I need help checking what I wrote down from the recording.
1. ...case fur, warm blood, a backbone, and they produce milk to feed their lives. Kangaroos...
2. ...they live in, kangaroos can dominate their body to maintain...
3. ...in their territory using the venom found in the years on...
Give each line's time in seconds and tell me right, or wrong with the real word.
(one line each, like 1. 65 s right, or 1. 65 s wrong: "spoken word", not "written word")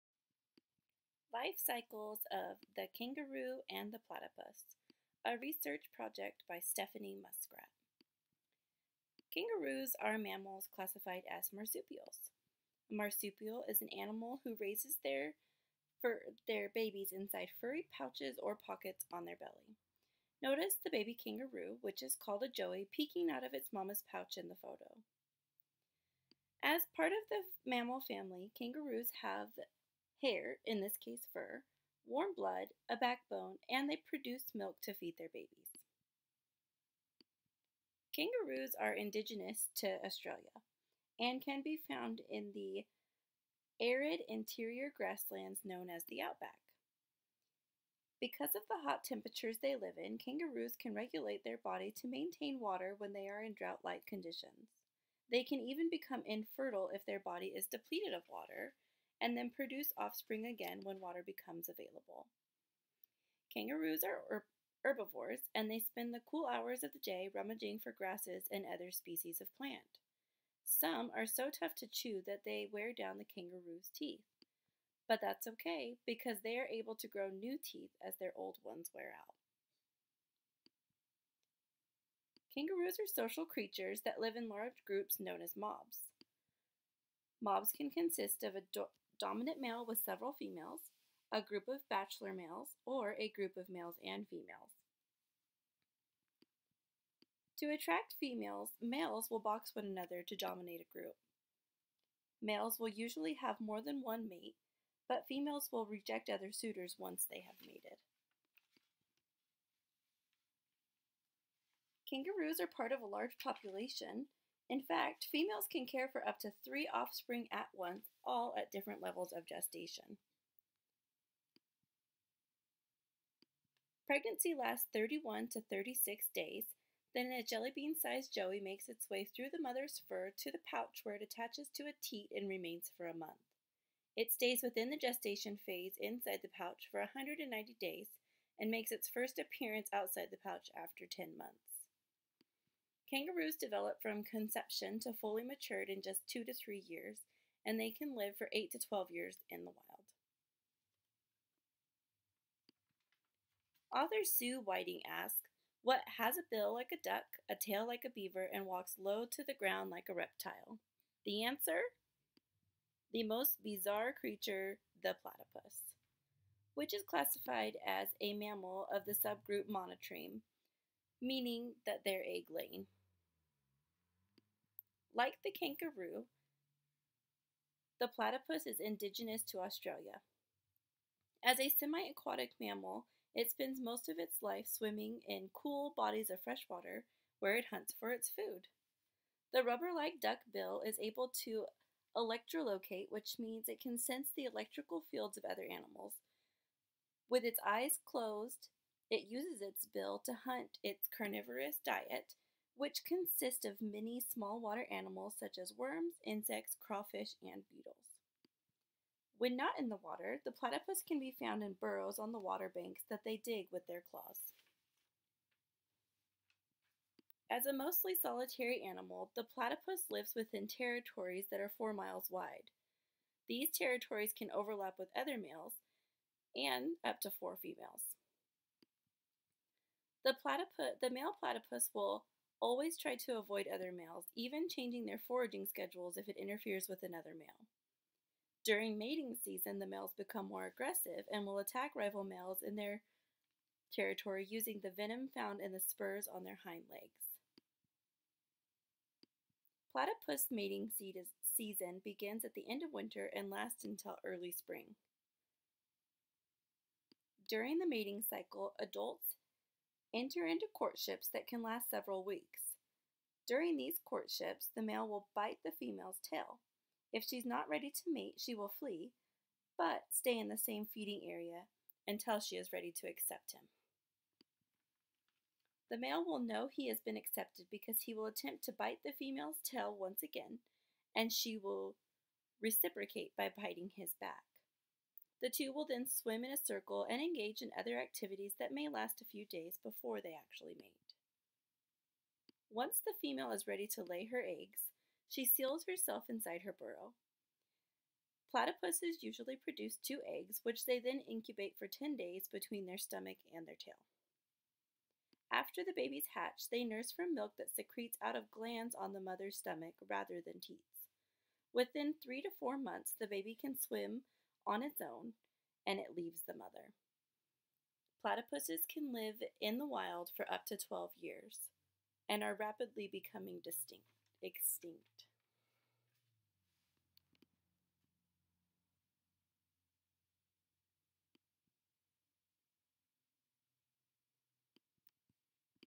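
1. 31 s wrong: "babies", not "lives"
2. 49 s wrong: "regulate", not "dominate"
3. 242 s wrong: "spurs", not "years".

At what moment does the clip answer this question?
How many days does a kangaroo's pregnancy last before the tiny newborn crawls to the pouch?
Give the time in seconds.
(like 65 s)
124 s.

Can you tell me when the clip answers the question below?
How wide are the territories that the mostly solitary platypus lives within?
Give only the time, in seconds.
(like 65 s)
221 s.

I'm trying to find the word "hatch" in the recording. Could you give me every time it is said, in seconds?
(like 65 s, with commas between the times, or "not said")
306 s.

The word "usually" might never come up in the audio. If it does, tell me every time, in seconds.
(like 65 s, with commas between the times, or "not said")
102 s, 299 s.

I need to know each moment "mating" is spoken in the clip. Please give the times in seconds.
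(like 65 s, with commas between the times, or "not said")
238 s, 250 s, 257 s.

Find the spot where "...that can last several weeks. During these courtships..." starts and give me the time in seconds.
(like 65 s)
261 s.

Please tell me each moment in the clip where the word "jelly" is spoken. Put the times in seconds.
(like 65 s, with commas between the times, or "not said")
127 s.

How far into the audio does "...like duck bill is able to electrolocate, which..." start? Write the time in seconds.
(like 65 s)
189 s.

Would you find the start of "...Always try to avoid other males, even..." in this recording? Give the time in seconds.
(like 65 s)
232 s.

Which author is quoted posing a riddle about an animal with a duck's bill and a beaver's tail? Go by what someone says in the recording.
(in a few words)
Sue Whiting.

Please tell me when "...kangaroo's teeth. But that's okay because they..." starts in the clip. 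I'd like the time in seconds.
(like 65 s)
73 s.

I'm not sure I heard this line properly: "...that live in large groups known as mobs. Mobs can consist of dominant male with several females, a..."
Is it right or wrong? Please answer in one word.
right.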